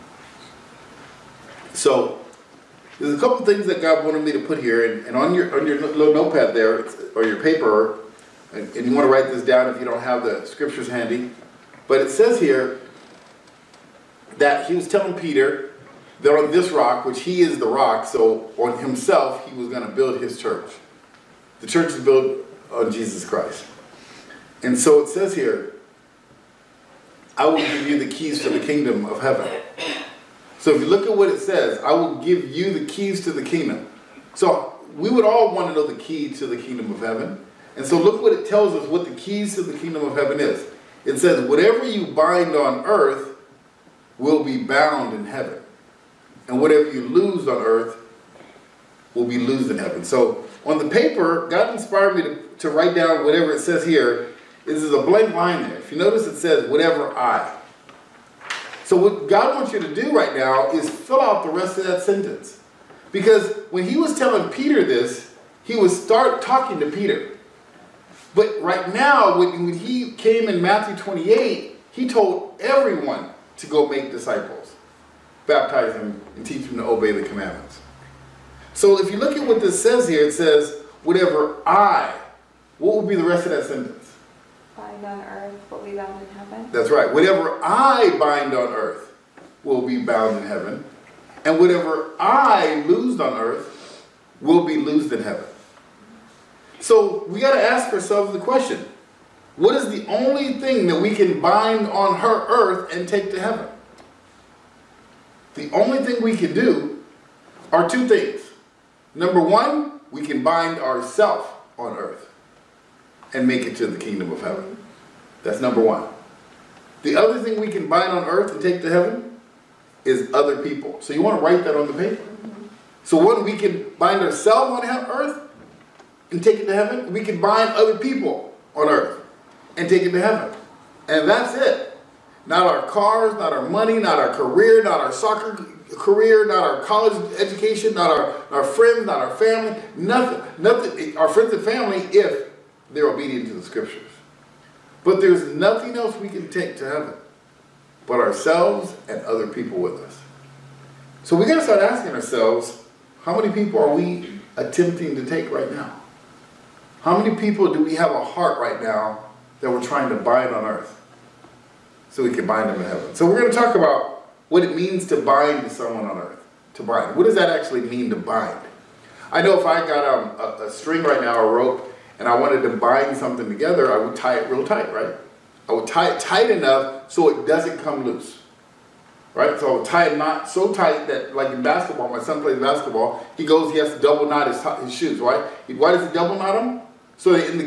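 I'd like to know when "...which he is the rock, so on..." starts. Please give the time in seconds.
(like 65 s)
17 s.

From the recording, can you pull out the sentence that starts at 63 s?
Because when he was telling Peter this, he would start talking to Peter.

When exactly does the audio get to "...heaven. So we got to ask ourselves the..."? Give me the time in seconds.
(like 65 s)
95 s.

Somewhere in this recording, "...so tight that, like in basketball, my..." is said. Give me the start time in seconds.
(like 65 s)
180 s.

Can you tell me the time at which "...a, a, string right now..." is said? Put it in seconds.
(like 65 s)
170 s.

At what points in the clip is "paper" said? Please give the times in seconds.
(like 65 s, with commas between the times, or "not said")
7 s, 50 s, 121 s.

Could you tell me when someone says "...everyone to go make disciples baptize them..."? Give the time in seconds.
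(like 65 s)
72 s.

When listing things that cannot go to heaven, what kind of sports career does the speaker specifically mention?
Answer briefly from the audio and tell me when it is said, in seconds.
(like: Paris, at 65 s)
Soccer career, at 135 s.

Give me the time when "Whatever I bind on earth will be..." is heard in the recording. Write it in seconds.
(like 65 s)
87 s.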